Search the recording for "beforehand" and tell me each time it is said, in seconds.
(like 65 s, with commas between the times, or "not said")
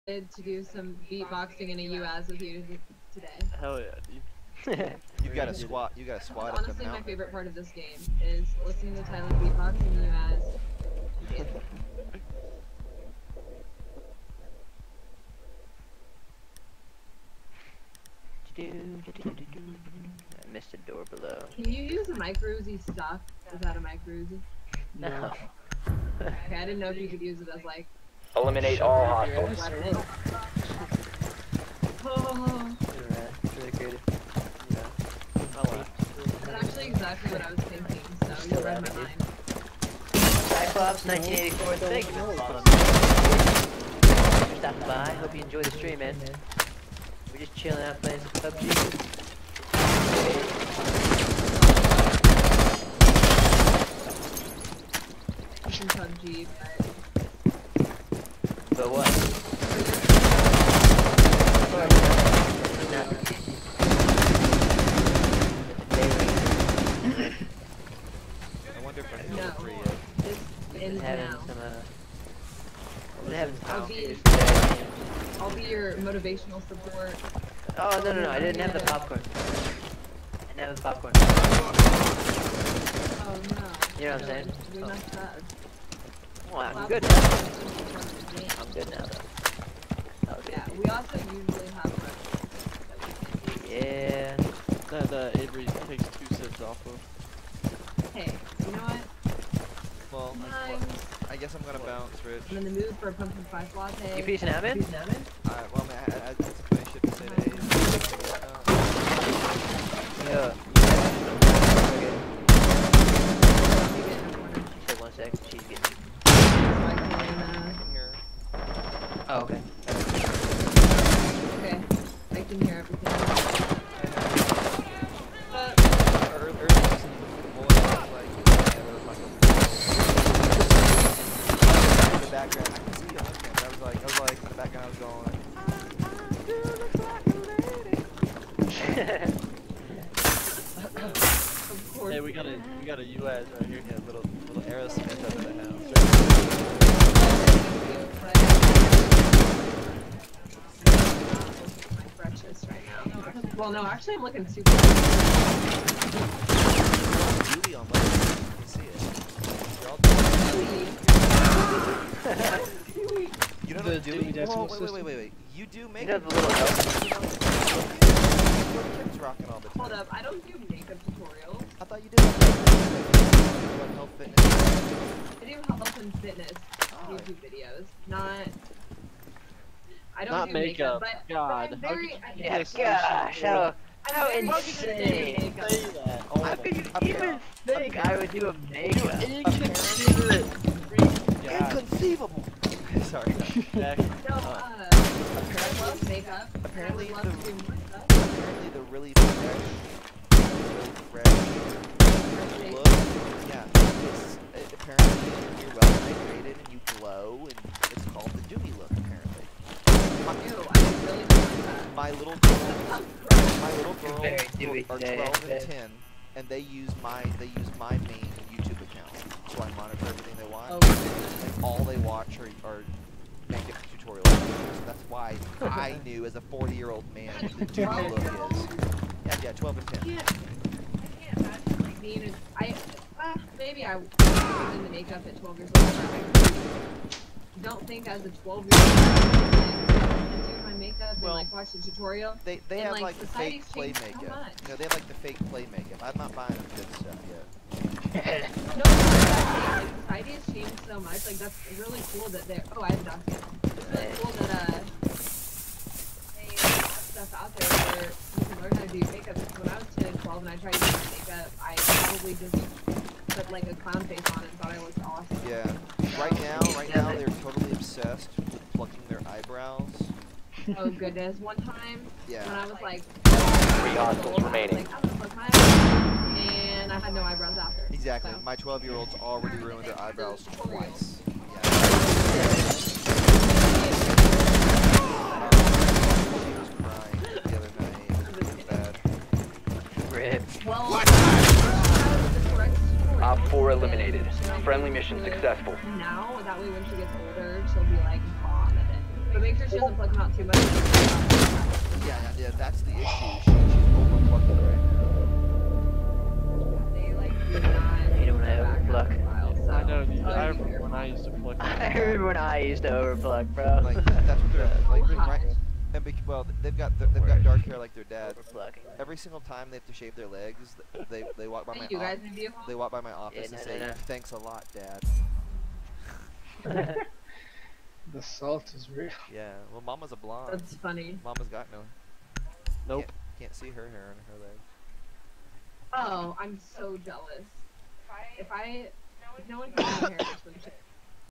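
not said.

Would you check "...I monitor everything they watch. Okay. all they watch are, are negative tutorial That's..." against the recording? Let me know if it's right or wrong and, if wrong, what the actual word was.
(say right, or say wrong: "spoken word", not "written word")
right.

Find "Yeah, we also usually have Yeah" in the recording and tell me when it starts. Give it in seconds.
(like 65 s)
90 s.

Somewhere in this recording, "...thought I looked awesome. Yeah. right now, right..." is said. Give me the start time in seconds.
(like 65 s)
264 s.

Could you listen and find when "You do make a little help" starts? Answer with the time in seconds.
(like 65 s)
165 s.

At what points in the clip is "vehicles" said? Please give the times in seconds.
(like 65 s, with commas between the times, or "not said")
not said.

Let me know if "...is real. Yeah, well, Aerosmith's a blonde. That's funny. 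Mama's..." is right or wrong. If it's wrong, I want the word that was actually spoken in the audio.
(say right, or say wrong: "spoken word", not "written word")
wrong: "Mama", not "Aerosmith".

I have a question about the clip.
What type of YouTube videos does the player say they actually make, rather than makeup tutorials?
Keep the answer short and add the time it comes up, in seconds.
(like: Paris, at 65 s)
Health and fitness, at 175 s.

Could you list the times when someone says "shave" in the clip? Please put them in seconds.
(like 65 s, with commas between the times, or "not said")
319 s.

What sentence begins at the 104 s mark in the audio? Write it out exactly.
Alright, well, I mean, I, I, I, I should say uh, Yeah.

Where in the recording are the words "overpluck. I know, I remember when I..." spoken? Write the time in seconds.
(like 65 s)
308 s.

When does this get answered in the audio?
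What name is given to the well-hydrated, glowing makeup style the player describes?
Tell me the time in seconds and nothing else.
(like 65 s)
208 s.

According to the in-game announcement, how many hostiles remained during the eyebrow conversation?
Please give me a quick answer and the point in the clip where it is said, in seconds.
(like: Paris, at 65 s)
3, at 273 s.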